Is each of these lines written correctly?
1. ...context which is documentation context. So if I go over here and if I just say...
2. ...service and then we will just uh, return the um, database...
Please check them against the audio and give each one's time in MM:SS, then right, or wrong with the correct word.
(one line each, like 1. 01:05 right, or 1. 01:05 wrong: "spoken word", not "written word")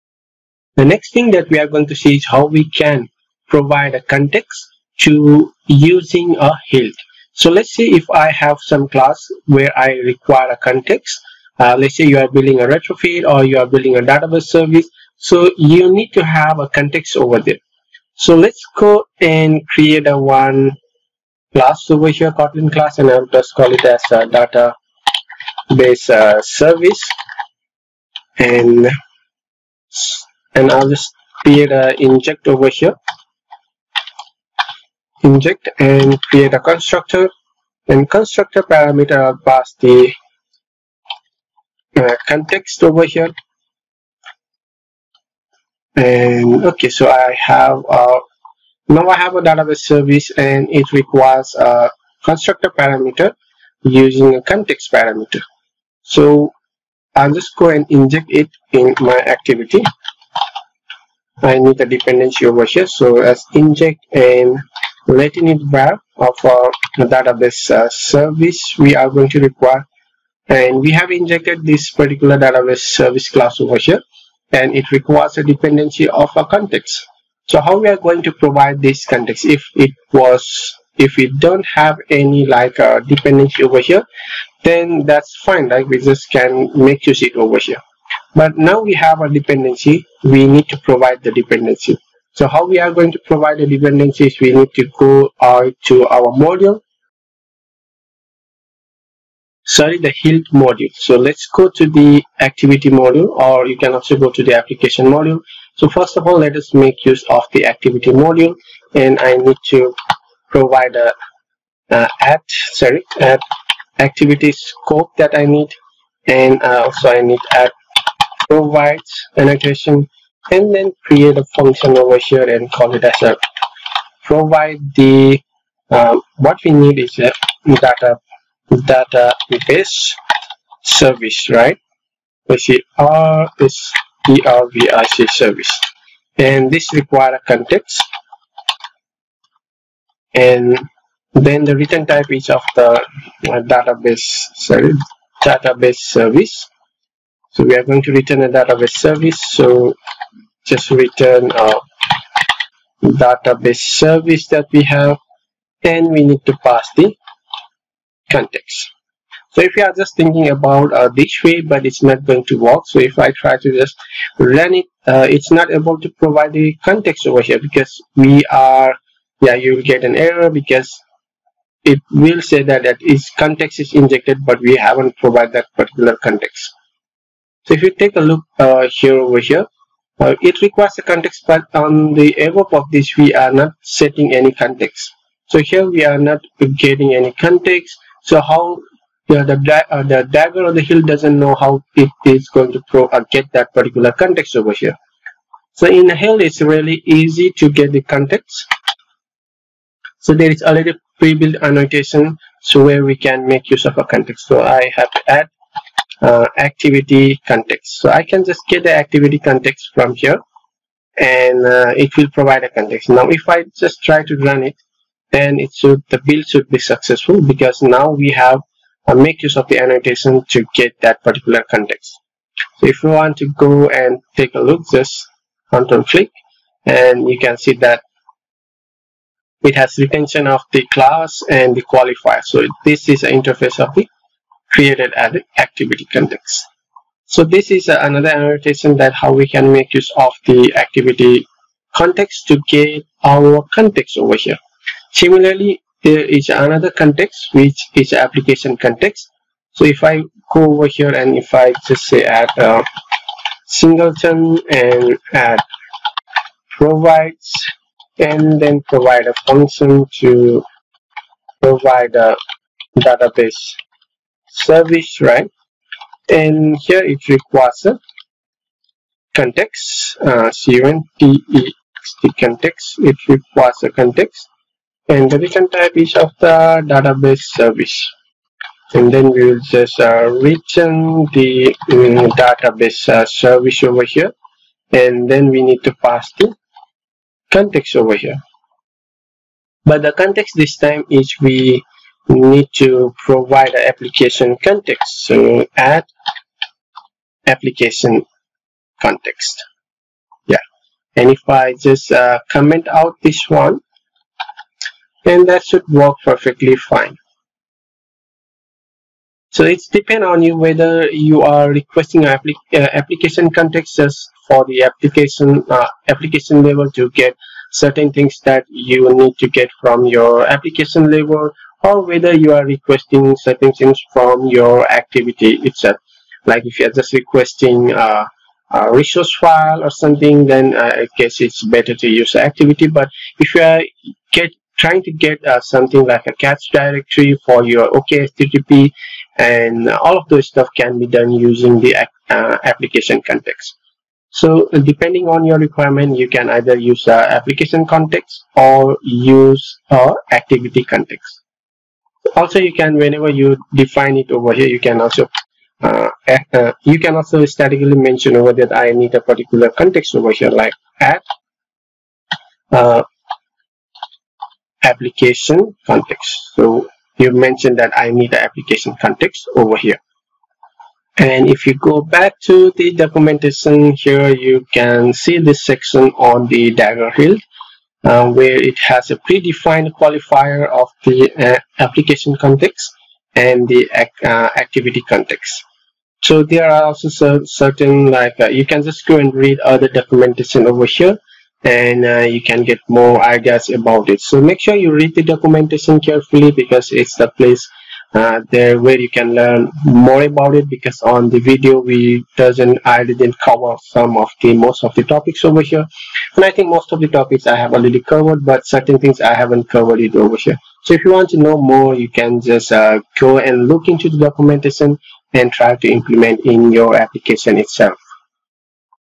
1. 04:06 wrong: "application", not "documentation"
2. 04:37 right.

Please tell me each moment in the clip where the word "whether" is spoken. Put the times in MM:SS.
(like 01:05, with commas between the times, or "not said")
05:10, 05:22.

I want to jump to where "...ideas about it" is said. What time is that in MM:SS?
06:33.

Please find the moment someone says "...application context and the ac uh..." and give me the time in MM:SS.
06:21.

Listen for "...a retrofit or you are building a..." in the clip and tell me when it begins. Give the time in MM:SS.
00:12.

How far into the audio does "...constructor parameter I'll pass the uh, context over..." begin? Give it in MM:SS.
00:38.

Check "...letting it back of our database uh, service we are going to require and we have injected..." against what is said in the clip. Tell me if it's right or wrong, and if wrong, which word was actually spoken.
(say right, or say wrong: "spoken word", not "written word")
right.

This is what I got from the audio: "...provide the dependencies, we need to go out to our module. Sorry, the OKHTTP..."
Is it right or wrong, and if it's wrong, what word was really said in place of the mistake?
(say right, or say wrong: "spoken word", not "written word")
wrong: "HILT", not "OKHTTP".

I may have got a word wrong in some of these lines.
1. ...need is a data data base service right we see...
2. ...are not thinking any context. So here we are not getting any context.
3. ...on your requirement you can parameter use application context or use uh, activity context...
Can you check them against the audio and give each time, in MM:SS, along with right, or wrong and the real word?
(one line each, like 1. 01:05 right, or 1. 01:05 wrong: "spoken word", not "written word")
1. 02:06 right
2. 03:03 wrong: "setting", not "thinking"
3. 05:45 wrong: "either", not "parameter".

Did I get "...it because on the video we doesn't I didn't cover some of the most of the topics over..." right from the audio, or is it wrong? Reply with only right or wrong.
right.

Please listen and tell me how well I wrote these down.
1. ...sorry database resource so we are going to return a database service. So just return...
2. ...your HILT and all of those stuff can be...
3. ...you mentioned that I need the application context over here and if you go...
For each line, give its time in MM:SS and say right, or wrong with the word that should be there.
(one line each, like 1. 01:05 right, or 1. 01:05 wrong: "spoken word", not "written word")
1. 02:24 wrong: "service", not "resource"
2. 05:37 wrong: "OKHTTP", not "HILT"
3. 06:07 right.